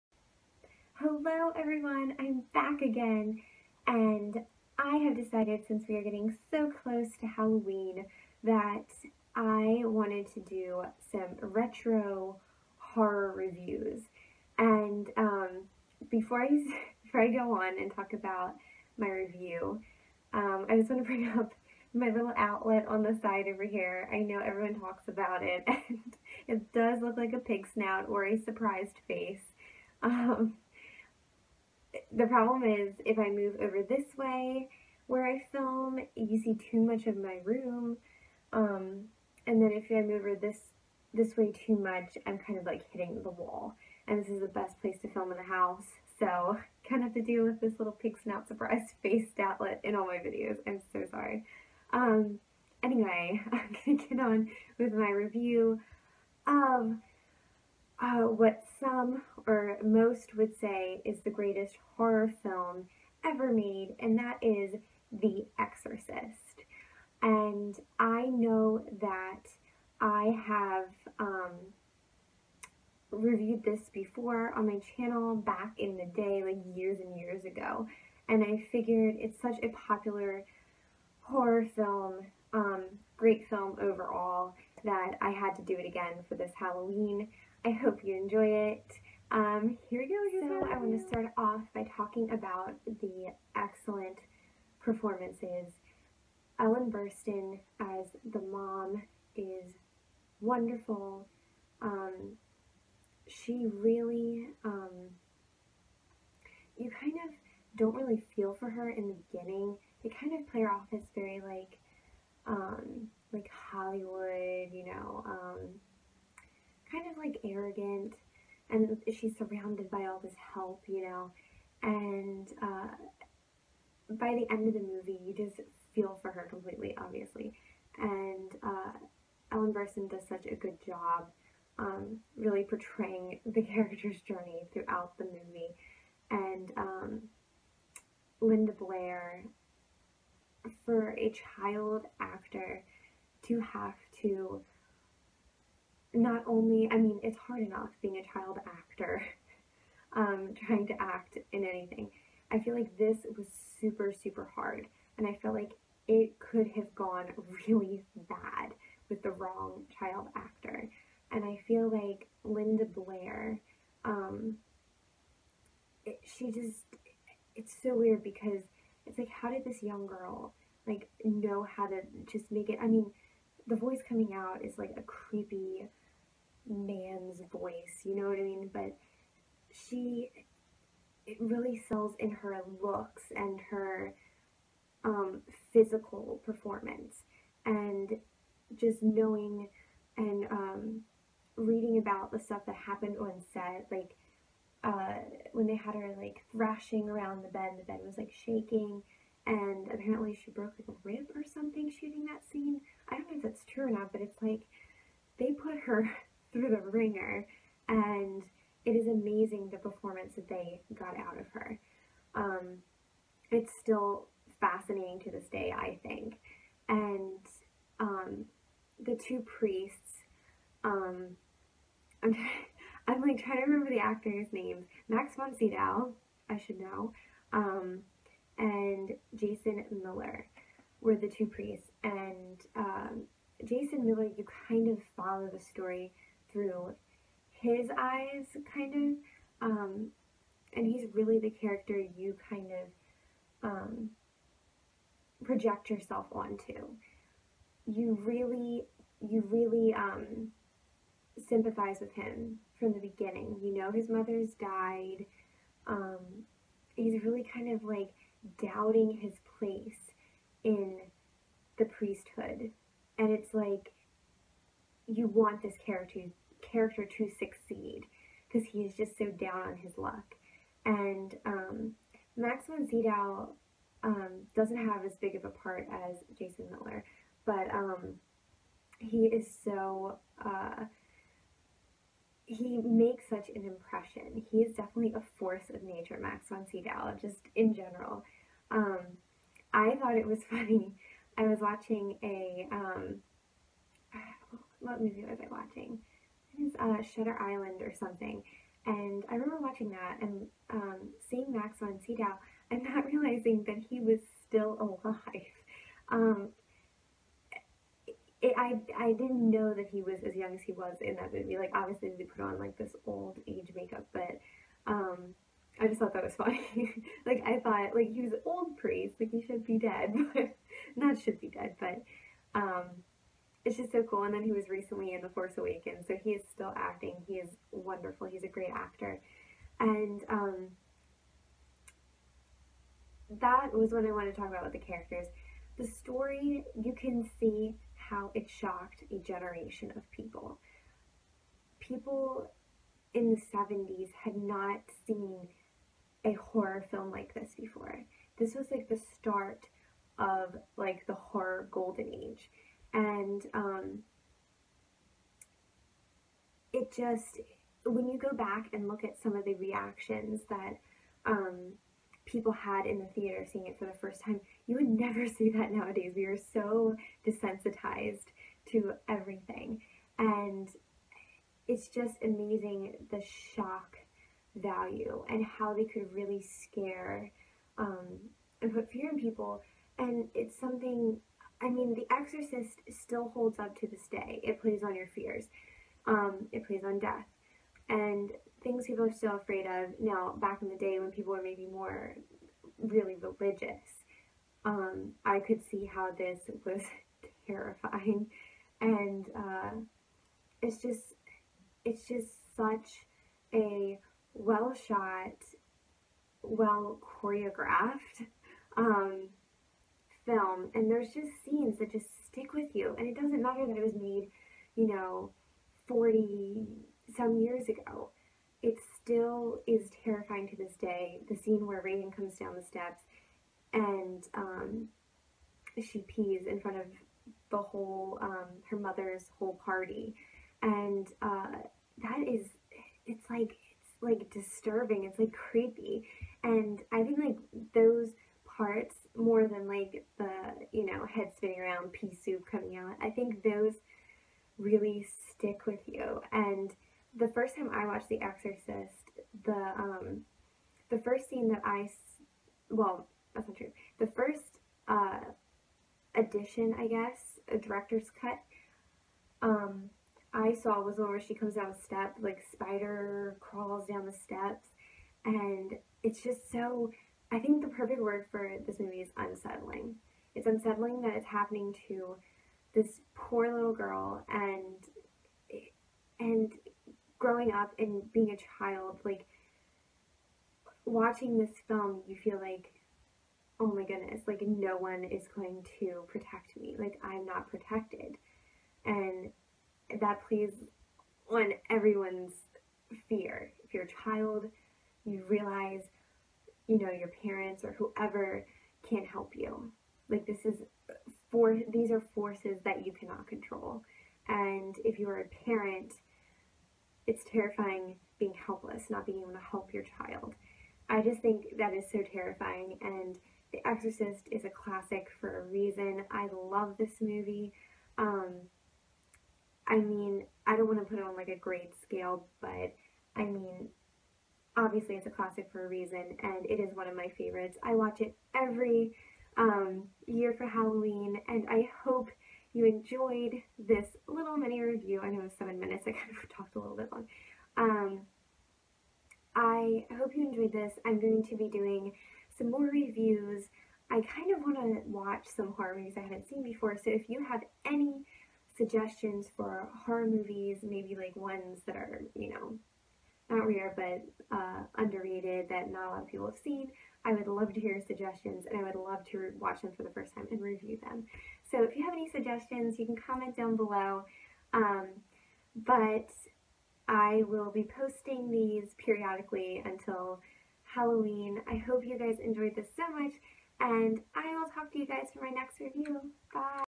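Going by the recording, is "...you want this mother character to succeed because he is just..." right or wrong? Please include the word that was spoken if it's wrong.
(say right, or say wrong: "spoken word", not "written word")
wrong: "character", not "mother".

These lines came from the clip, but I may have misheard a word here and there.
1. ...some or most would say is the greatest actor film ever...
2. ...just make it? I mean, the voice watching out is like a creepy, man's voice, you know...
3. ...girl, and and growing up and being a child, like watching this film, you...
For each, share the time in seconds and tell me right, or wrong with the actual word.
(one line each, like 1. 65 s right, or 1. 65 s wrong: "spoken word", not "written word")
1. 58 s wrong: "horror", not "actor"
2. 172 s wrong: "coming", not "watching"
3. 473 s right.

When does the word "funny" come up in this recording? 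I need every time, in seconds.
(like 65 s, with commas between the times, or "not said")
290 s, 316 s.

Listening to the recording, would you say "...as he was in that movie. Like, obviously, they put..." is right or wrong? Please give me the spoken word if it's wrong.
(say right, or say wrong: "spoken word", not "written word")
right.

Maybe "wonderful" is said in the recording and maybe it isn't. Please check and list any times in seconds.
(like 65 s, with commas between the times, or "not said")
100 s, 327 s.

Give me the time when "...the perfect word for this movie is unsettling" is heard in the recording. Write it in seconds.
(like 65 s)
467 s.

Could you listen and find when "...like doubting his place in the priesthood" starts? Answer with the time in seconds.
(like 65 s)
257 s.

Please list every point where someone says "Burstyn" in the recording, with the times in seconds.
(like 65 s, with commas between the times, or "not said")
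96 s, 129 s.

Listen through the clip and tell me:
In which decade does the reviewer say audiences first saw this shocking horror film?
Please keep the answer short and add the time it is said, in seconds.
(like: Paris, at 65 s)
The 70s, at 343 s.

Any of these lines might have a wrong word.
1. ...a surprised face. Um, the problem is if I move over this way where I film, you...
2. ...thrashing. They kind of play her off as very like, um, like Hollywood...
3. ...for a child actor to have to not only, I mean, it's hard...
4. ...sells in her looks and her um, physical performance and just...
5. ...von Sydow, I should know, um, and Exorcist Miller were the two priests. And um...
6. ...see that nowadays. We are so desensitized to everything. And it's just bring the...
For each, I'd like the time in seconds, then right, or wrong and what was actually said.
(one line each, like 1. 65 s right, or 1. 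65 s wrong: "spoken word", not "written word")
1. 28 s right
2. 109 s wrong: "beginning", not "thrashing"
3. 140 s right
4. 181 s right
5. 225 s wrong: "Jason", not "Exorcist"
6. 365 s wrong: "amazing", not "bring".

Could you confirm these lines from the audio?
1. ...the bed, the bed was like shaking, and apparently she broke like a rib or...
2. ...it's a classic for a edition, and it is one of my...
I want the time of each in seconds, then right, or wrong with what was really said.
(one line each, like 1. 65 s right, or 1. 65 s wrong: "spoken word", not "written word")
1. 197 s right
2. 524 s wrong: "reason", not "edition".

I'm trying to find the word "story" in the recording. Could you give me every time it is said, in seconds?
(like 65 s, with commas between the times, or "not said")
235 s, 335 s.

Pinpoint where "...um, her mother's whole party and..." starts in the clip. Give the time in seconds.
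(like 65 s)
428 s.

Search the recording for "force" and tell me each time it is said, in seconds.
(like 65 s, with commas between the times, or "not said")
285 s, 325 s, 502 s.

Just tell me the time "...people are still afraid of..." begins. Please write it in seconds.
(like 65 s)
388 s.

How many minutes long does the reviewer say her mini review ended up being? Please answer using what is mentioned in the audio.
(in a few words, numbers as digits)
7.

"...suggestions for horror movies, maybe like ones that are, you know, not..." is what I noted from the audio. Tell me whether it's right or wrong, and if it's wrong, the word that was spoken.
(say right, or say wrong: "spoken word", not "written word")
right.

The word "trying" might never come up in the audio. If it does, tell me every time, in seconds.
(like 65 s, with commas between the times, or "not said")
150 s, 223 s.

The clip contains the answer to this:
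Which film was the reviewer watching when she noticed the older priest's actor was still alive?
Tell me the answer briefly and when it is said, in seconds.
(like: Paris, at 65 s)
Shutter Island, at 297 s.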